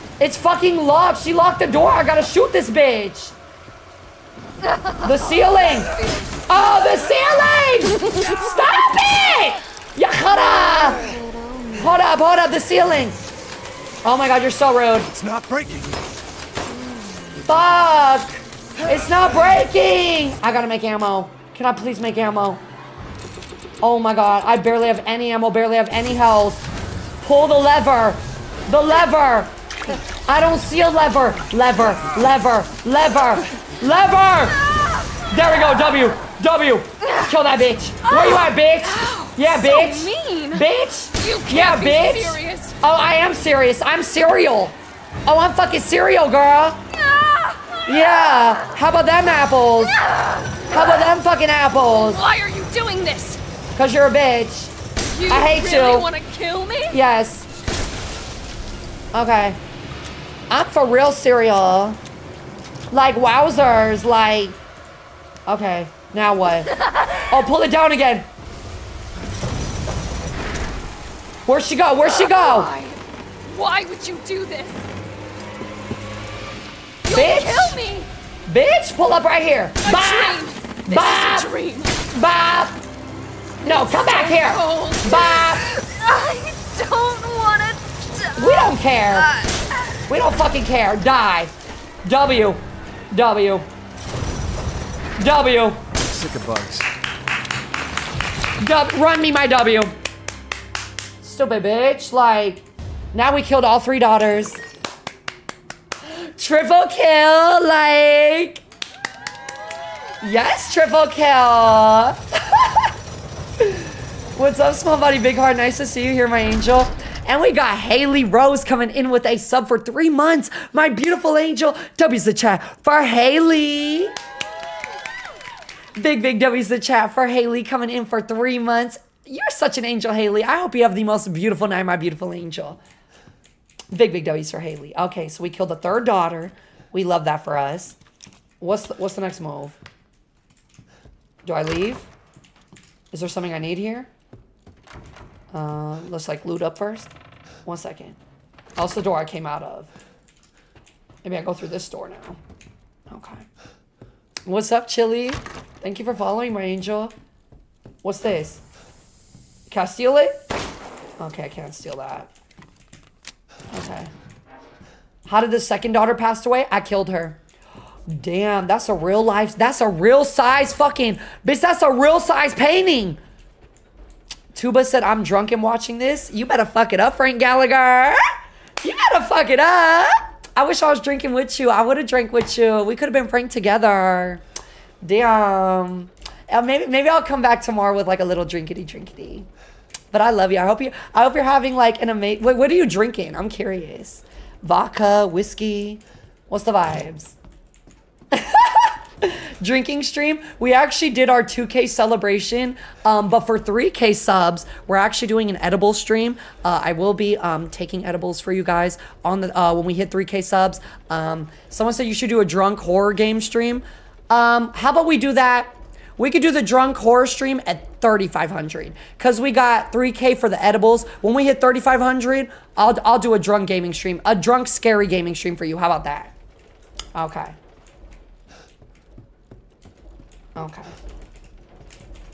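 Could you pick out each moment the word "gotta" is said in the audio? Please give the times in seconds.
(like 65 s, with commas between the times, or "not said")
2 s, 20 s.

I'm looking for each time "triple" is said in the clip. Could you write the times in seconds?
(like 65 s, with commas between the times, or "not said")
106 s, 110 s.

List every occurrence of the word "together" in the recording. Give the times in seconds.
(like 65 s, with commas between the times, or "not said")
183 s.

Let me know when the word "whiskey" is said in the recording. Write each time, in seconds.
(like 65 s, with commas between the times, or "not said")
195 s.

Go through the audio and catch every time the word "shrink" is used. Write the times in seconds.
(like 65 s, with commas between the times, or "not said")
not said.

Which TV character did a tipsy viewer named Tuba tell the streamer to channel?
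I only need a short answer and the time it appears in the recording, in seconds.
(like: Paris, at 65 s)
Frank Gallagher, at 177 s.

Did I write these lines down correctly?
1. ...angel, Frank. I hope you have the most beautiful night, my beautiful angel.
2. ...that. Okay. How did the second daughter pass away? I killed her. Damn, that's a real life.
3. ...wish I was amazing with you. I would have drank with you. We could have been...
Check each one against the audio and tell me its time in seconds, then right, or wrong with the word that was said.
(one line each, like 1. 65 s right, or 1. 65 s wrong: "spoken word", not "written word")
1. 129 s wrong: "Haley", not "Frank"
2. 161 s right
3. 180 s wrong: "drinking", not "amazing".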